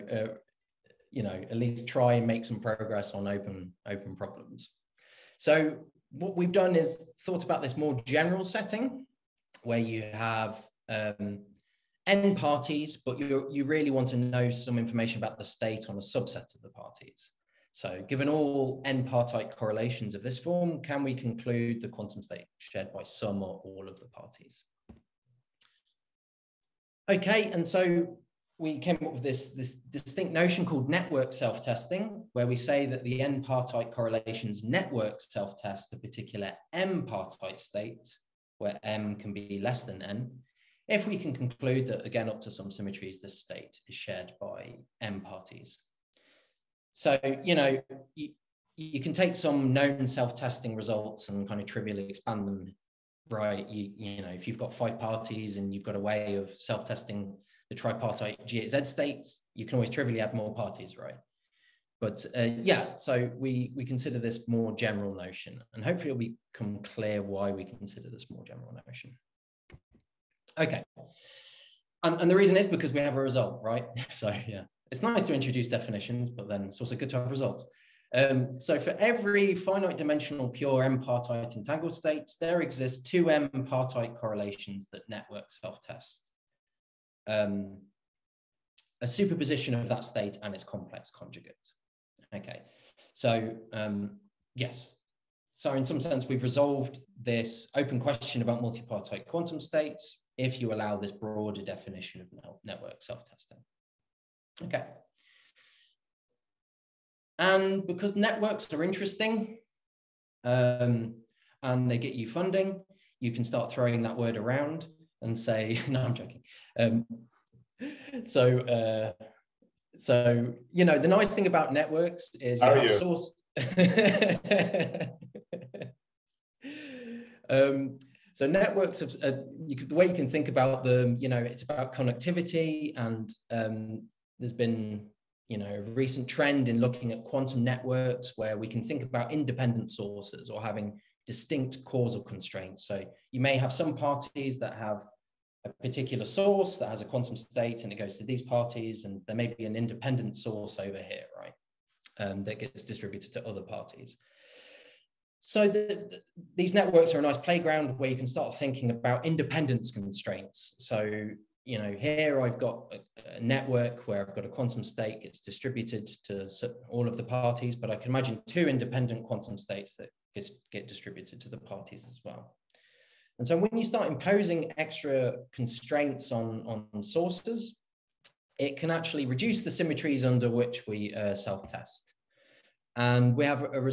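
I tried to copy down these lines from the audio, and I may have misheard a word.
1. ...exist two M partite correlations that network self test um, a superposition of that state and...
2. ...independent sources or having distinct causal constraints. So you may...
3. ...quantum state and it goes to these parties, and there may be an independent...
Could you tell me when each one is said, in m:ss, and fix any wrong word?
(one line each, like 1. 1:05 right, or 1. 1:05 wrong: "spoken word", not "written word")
1. 1:22 right
2. 2:19 right
3. 2:27 right.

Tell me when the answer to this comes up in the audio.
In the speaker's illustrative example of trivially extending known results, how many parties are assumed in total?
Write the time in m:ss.
0:54.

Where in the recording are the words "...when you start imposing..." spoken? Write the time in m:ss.
2:53.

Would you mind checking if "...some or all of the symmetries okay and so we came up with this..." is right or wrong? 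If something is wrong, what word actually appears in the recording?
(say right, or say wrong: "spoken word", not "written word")
wrong: "parties", not "symmetries".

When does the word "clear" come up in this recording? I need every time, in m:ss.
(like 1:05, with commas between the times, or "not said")
1:06.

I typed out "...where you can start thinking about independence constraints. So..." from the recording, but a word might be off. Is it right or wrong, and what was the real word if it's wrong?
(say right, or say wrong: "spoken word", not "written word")
right.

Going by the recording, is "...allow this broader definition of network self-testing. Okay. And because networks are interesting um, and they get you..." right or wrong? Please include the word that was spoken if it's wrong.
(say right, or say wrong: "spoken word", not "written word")
right.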